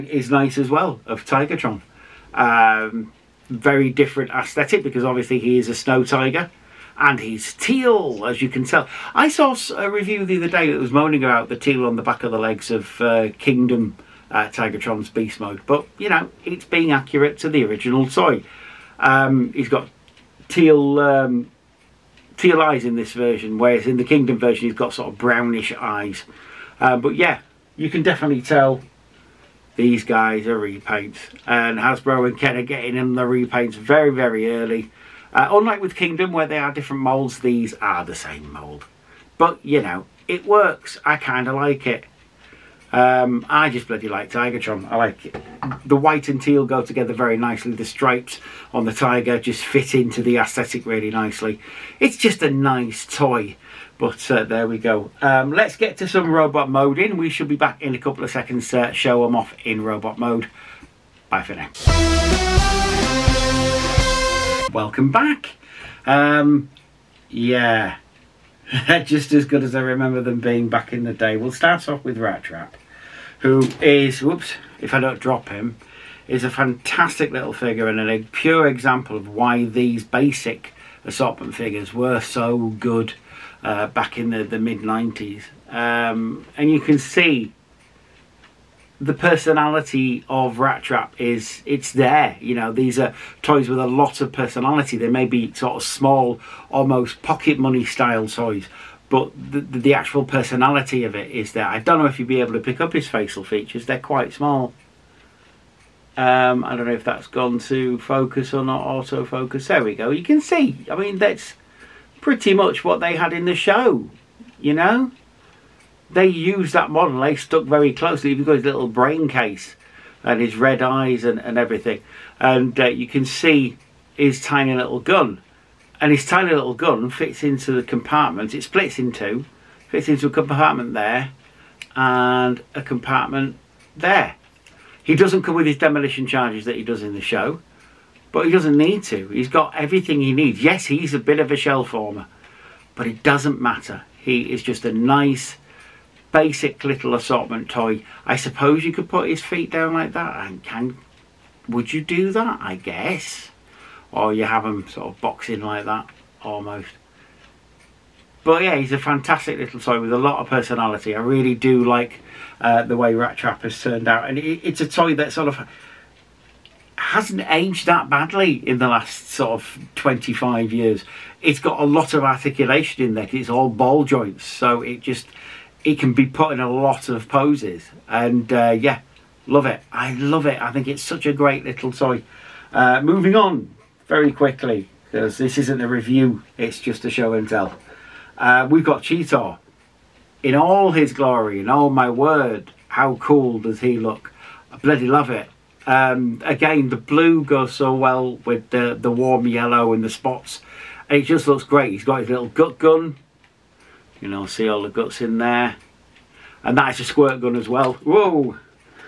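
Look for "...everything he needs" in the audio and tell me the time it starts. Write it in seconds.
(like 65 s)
139 s.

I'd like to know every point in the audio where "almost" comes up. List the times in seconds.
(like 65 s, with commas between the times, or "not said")
96 s, 156 s.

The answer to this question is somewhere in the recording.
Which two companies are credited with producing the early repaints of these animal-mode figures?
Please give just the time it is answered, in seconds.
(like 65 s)
31 s.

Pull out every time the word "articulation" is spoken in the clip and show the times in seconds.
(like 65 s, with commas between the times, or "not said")
172 s.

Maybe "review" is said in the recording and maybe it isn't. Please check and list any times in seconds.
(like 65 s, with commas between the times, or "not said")
9 s, 185 s.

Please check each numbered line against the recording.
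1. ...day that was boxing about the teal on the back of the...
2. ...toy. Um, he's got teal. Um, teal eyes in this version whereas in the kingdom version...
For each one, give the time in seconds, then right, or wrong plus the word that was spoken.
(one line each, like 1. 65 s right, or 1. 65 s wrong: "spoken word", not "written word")
1. 10 s wrong: "moaning", not "boxing"
2. 18 s right.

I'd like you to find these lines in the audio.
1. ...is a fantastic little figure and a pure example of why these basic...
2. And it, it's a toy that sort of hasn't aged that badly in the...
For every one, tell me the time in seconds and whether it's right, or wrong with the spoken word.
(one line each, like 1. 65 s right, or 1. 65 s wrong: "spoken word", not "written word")
1. 76 s right
2. 164 s right.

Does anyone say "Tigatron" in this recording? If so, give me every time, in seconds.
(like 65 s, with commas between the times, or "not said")
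1 s, 14 s, 44 s.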